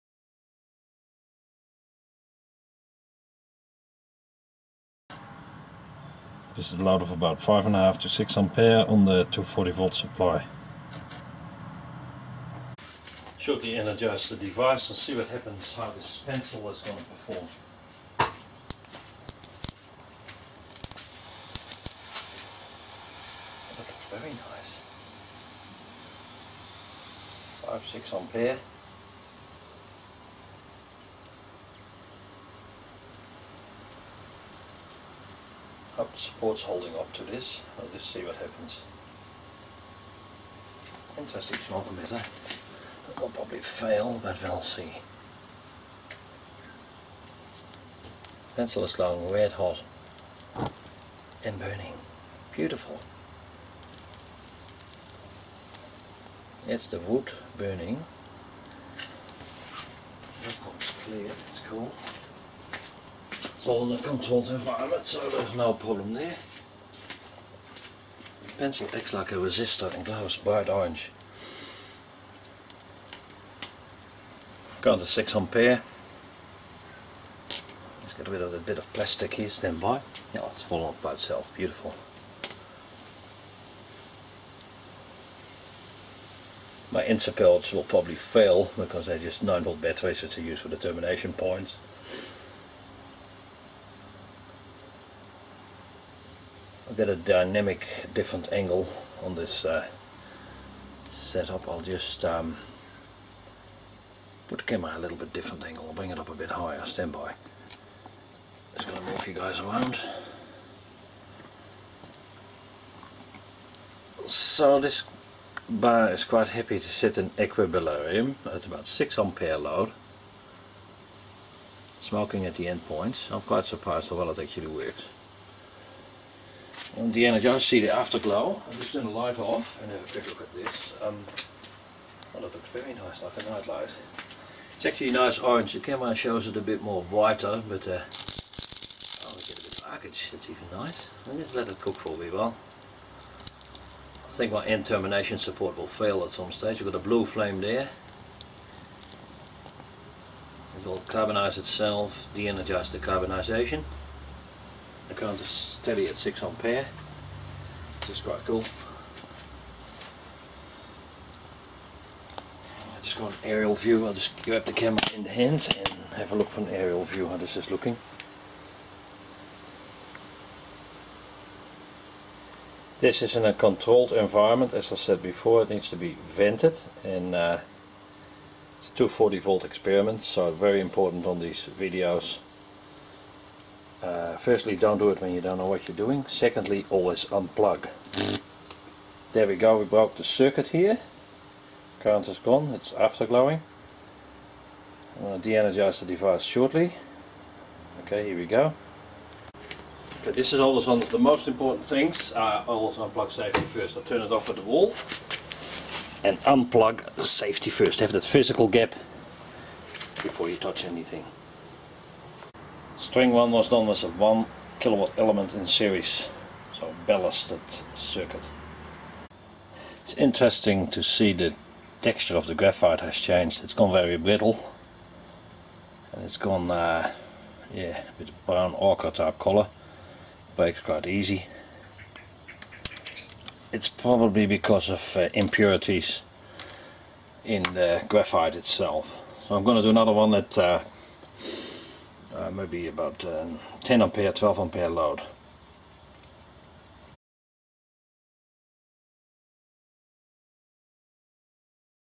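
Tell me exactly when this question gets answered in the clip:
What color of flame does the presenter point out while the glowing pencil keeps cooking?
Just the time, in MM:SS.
02:27.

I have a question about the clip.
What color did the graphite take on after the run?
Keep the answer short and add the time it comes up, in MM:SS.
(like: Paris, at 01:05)
Brown ochre, at 03:48.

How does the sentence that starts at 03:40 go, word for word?
It's interesting to see the texture of the graphite has changed.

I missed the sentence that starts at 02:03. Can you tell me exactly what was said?
I'm quite surprised how well it actually works on the Energizer see the afterglow.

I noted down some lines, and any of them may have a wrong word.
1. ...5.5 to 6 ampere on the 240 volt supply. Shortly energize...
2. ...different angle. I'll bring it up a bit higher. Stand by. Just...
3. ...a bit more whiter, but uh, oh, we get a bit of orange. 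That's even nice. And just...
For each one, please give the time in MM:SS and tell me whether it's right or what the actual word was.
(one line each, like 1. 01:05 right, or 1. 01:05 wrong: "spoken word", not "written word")
1. 00:07 right
2. 01:45 right
3. 02:16 wrong: "arcage", not "orange".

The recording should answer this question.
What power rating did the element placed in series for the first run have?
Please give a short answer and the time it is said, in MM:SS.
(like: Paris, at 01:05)
1 kilowatt, at 03:34.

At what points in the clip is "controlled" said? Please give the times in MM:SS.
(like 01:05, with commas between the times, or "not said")
01:04, 02:53.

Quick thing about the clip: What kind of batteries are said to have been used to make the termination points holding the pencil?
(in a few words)
9 volt batteries.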